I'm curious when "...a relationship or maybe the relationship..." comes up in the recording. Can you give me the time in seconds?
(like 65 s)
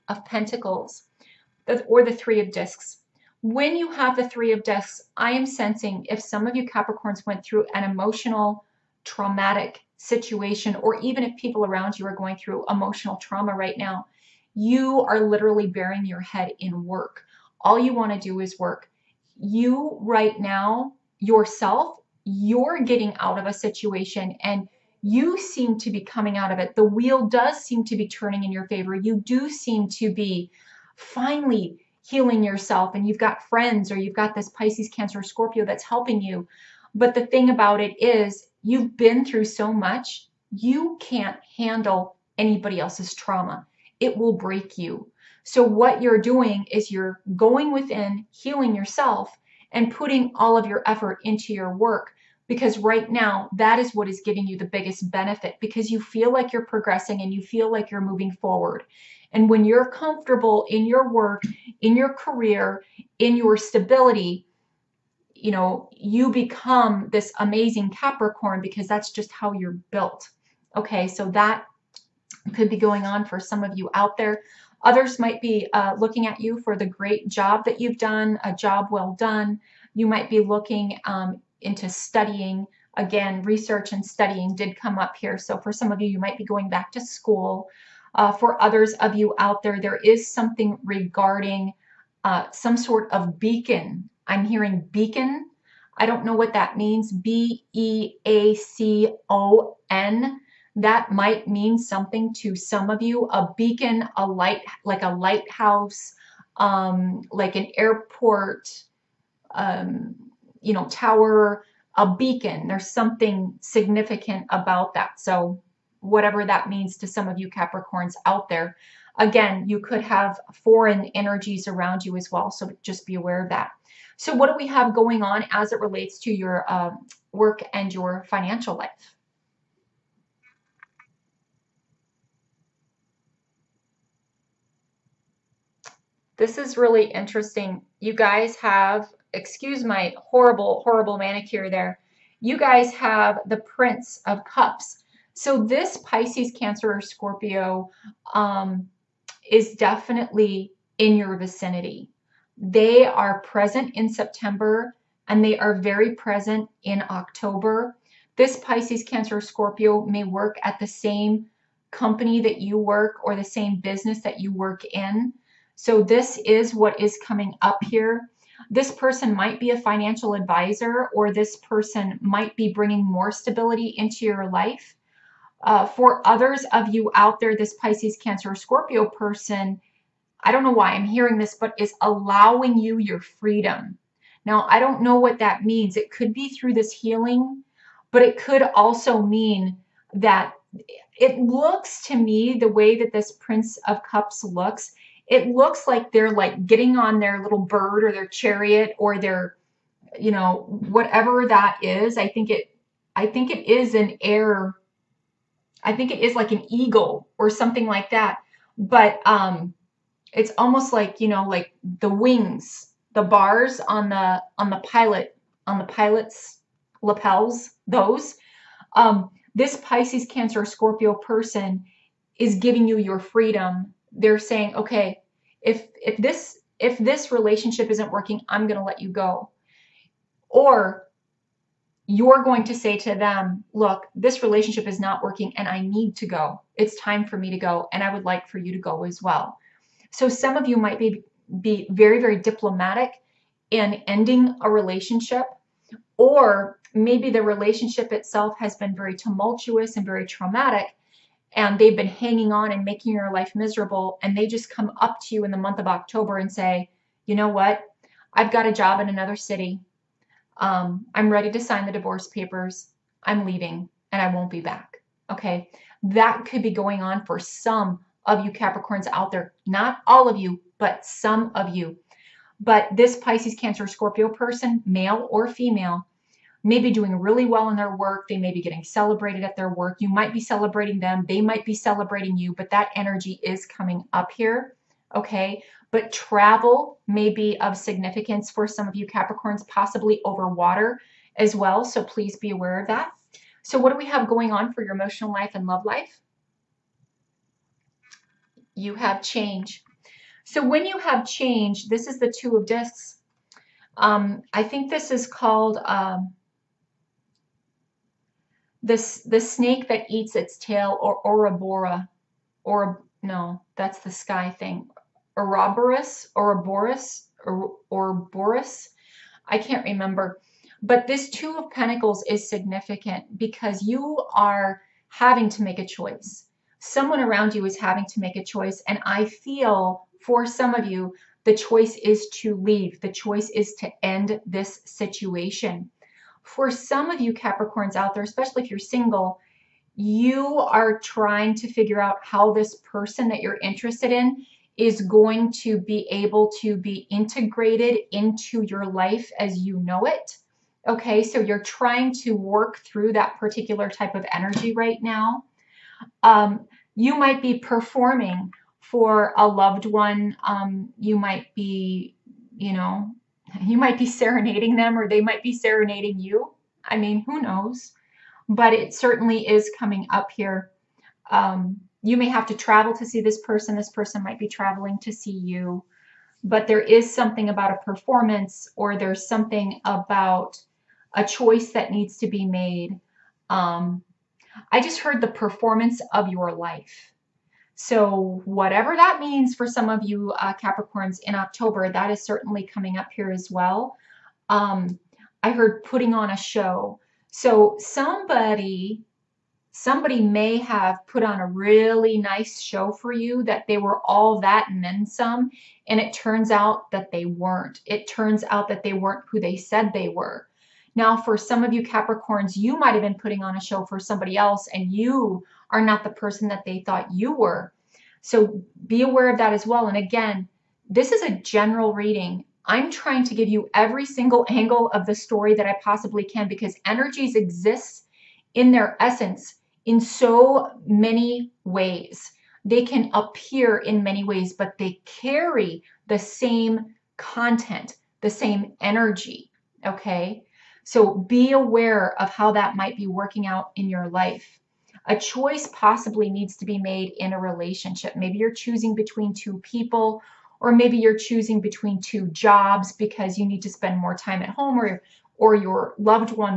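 244 s.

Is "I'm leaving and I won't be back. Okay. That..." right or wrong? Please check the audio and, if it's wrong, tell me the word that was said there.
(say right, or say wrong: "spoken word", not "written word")
right.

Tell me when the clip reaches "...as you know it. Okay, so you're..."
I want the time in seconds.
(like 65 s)
349 s.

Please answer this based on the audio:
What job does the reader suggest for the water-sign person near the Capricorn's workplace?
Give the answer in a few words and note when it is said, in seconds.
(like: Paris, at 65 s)
Financial advisor, at 169 s.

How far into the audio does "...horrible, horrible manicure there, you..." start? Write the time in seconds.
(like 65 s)
140 s.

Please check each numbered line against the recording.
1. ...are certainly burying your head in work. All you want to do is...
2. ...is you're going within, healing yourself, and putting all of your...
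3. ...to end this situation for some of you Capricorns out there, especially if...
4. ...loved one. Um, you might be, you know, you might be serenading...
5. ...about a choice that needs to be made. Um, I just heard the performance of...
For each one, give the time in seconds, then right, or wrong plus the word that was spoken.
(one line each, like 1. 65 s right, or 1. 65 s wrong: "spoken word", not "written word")
1. 15 s wrong: "literally", not "certainly"
2. 46 s right
3. 333 s right
4. 359 s right
5. 379 s right.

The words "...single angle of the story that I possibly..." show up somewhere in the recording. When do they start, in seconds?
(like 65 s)
424 s.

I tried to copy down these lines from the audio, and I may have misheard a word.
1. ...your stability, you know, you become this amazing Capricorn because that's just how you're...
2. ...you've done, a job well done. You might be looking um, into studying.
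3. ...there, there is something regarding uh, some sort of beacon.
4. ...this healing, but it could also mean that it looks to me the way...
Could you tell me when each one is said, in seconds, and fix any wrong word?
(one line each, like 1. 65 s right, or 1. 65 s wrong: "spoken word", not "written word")
1. 63 s right
2. 77 s right
3. 89 s right
4. 186 s right.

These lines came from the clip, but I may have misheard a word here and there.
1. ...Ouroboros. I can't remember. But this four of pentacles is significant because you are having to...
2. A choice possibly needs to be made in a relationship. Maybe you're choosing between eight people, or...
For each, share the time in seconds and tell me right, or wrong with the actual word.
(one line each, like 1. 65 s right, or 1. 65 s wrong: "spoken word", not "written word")
1. 317 s wrong: "two", not "four"
2. 445 s wrong: "two", not "eight".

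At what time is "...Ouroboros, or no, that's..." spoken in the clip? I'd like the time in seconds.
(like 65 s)
311 s.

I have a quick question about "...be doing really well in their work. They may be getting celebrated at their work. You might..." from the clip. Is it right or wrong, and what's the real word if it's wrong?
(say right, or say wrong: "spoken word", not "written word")
right.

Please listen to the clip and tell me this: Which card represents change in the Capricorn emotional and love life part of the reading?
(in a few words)
Two of Discs.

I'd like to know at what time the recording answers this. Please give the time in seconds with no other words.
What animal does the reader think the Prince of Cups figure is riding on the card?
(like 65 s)
206 s.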